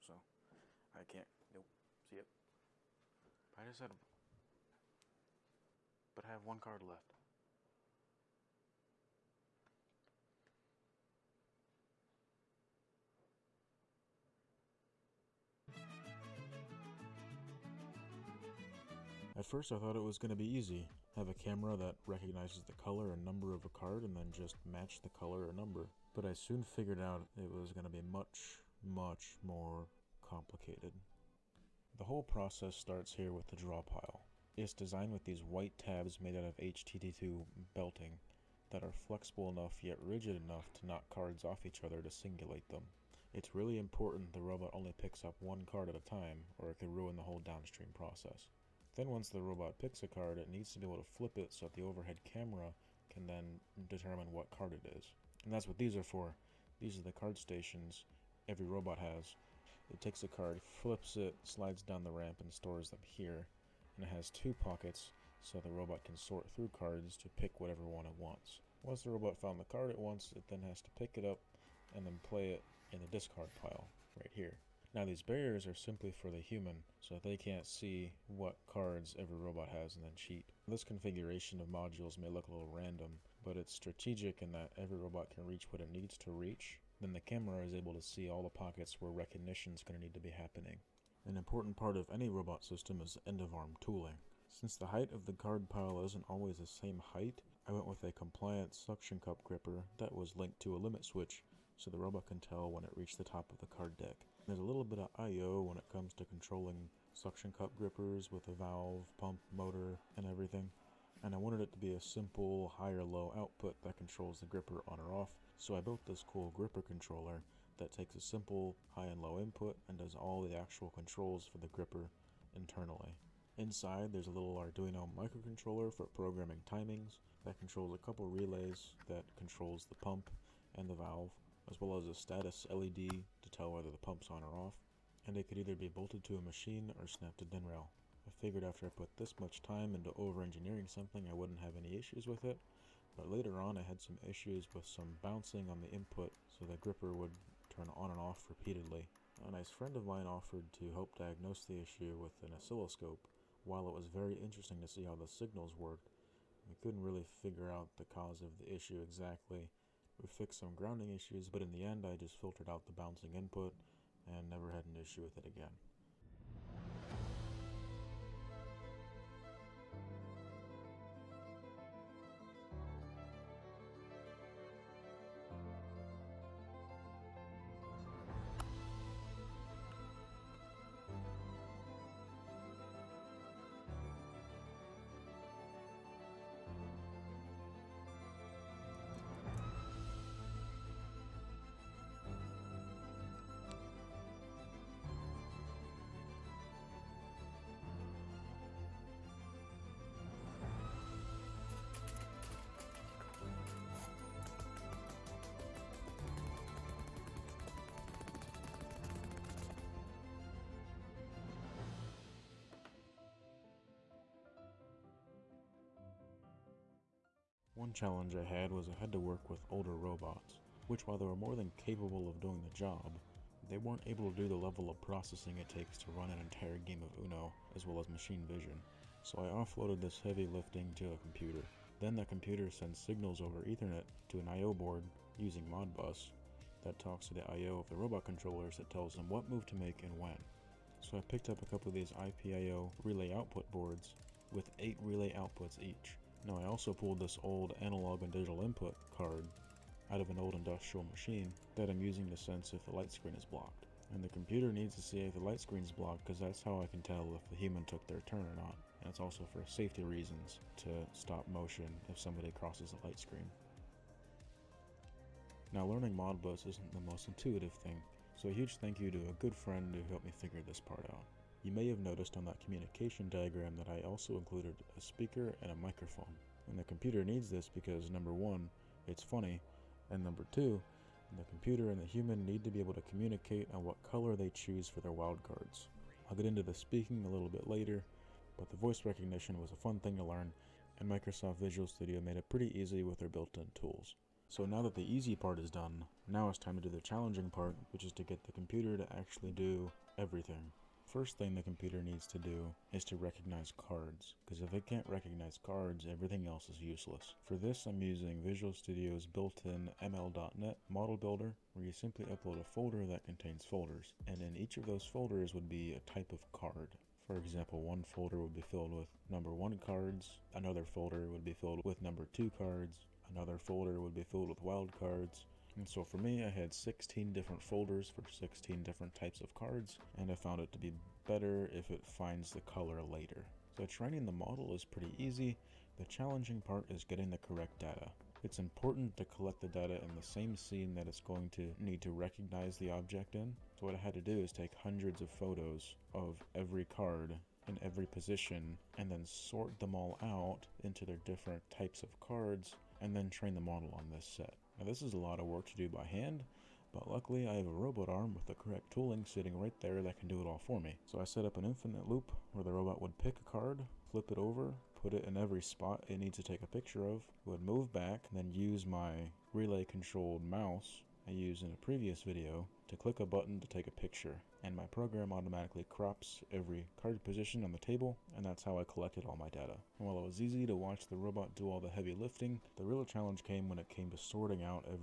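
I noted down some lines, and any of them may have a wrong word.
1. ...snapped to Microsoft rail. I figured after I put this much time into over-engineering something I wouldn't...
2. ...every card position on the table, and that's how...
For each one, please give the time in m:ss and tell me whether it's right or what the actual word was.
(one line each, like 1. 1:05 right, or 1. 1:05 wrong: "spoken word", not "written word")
1. 2:17 wrong: "DIN", not "Microsoft"
2. 6:16 right.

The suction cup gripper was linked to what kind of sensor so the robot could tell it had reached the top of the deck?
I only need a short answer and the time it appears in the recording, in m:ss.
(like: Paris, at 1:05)
limit switch, at 1:40.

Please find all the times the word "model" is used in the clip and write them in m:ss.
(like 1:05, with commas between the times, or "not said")
5:10, 5:34, 5:53.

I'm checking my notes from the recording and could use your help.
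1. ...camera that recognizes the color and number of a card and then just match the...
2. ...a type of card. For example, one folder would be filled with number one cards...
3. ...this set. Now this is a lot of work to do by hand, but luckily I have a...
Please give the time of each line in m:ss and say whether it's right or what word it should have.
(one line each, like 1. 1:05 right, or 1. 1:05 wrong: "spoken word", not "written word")
1. 0:21 right
2. 5:15 right
3. 5:54 right.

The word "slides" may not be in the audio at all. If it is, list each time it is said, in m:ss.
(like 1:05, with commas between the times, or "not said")
1:01.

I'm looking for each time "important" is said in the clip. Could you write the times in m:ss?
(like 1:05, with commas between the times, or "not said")
0:43, 1:31, 5:38.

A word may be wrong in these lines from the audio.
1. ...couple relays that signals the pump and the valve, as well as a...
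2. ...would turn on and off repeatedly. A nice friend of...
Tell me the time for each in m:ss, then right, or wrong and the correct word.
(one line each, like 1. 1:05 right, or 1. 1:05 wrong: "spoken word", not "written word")
1. 2:08 wrong: "controls", not "signals"
2. 2:27 right.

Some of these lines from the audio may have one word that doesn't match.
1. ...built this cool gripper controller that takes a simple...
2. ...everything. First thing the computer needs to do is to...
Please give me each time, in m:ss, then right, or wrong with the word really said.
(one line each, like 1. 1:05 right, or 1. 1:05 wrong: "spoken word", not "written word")
1. 1:55 right
2. 5:00 right.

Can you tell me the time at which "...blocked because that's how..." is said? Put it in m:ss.
4:15.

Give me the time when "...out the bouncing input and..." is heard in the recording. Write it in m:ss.
2:42.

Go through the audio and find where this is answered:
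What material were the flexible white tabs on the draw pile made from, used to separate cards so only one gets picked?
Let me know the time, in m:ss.
0:36.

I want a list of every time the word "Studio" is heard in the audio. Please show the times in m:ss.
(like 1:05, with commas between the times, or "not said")
4:51, 5:08.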